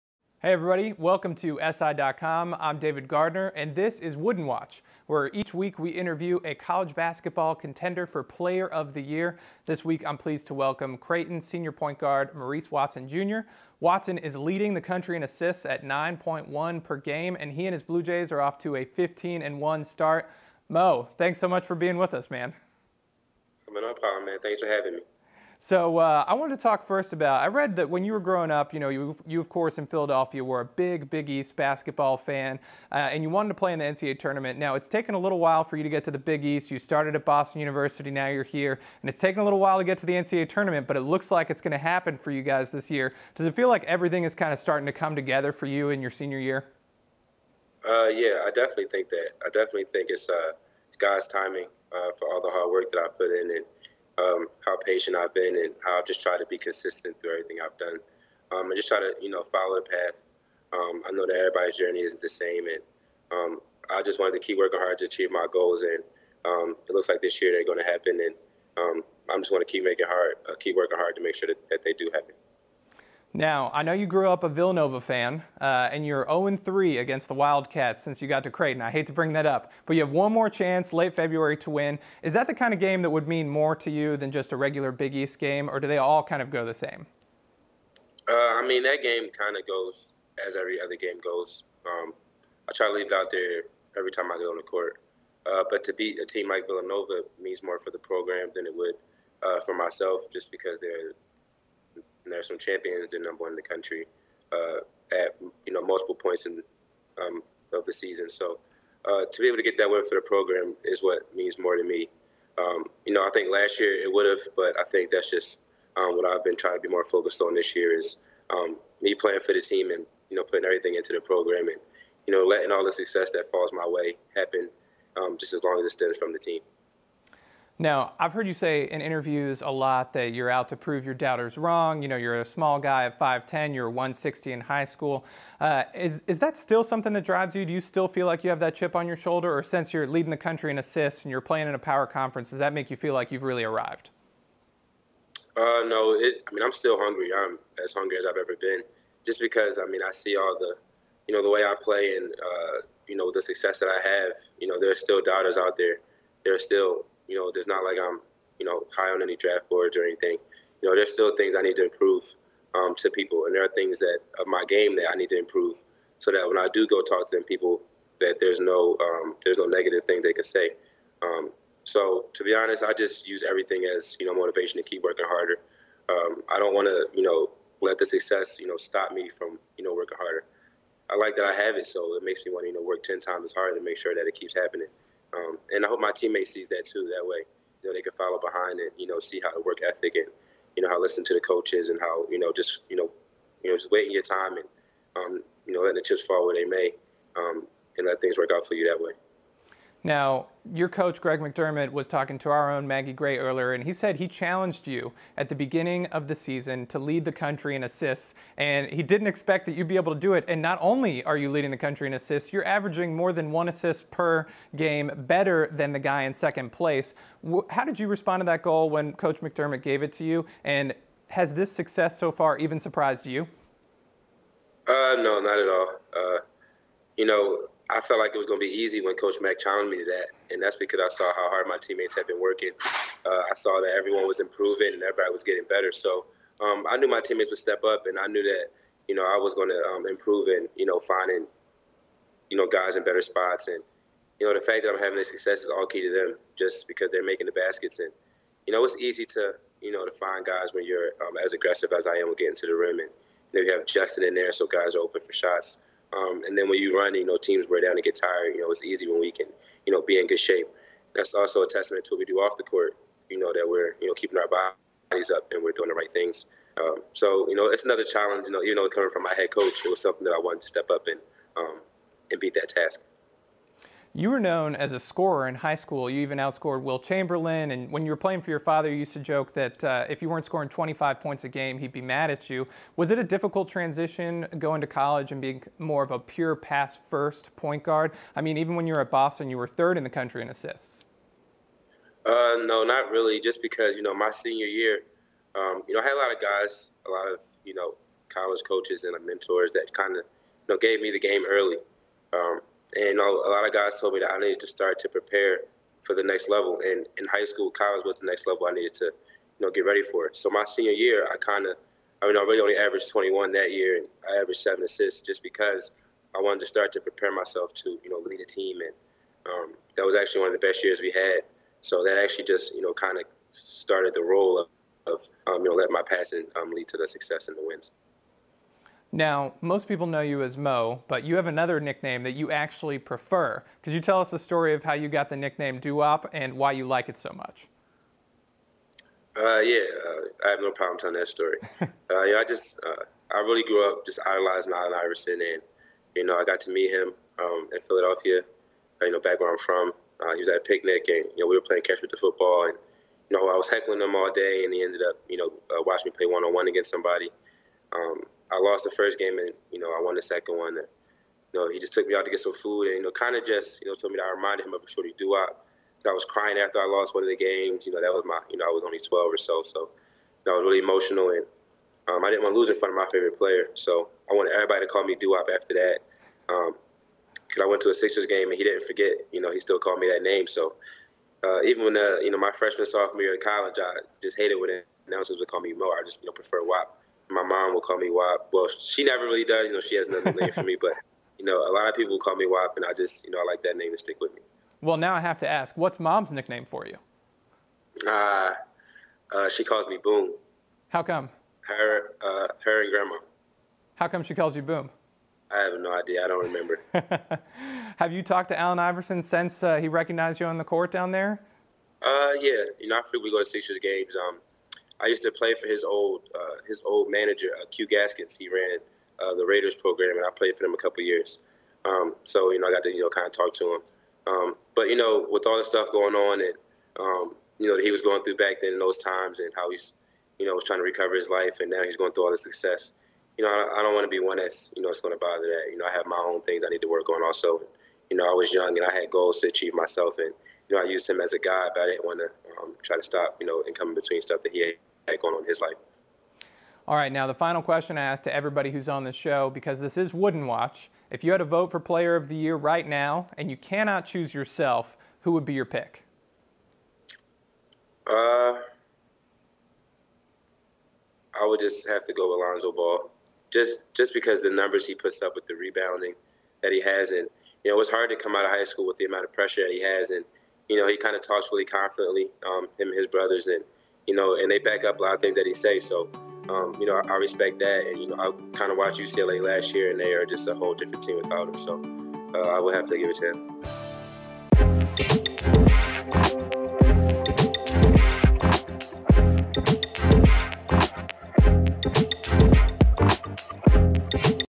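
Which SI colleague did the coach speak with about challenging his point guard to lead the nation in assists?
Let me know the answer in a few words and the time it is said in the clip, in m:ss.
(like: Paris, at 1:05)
Maggie Gray, at 3:22.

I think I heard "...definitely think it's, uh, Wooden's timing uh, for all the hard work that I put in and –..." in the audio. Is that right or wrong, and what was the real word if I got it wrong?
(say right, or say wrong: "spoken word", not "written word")
wrong: "God", not "Wooden".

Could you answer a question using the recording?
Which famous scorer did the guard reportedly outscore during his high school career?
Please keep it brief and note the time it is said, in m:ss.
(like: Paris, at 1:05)
Wilt Chamberlain, at 4:36.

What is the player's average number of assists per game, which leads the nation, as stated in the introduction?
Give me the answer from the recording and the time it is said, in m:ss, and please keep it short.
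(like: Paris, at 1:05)
9.1, at 0:15.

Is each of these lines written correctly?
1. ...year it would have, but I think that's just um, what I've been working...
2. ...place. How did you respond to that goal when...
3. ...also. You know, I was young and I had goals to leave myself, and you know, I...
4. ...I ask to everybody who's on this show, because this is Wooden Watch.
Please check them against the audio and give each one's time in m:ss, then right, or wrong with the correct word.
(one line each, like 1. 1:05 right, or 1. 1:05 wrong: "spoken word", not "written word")
1. 1:53 wrong: "trying", not "working"
2. 3:36 right
3. 7:17 wrong: "achieve", not "leave"
4. 7:27 right.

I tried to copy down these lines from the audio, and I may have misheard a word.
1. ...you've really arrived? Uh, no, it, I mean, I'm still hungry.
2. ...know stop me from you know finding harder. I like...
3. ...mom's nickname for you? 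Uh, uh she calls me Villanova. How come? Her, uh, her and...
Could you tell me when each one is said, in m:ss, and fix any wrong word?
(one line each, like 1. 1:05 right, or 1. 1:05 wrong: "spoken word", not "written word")
1. 2:23 right
2. 2:58 wrong: "working", not "finding"
3. 6:35 wrong: "Boom", not "Villanova".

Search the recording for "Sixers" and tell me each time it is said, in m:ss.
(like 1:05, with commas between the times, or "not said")
6:17, 6:53.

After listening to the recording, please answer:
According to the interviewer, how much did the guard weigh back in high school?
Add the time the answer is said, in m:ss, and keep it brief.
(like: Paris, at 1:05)
160, at 2:13.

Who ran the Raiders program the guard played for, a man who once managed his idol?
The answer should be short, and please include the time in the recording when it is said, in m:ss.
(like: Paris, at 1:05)
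Q Gaskins, at 6:57.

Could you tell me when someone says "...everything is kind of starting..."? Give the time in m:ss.
0:43.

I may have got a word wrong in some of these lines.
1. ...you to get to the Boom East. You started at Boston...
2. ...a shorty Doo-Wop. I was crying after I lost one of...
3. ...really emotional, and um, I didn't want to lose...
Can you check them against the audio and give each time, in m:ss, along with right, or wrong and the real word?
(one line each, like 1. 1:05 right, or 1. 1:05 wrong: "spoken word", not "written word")
1. 0:35 wrong: "Big", not "Boom"
2. 6:04 right
3. 6:10 right.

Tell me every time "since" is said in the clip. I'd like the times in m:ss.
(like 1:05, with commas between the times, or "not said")
1:18, 2:19, 6:49.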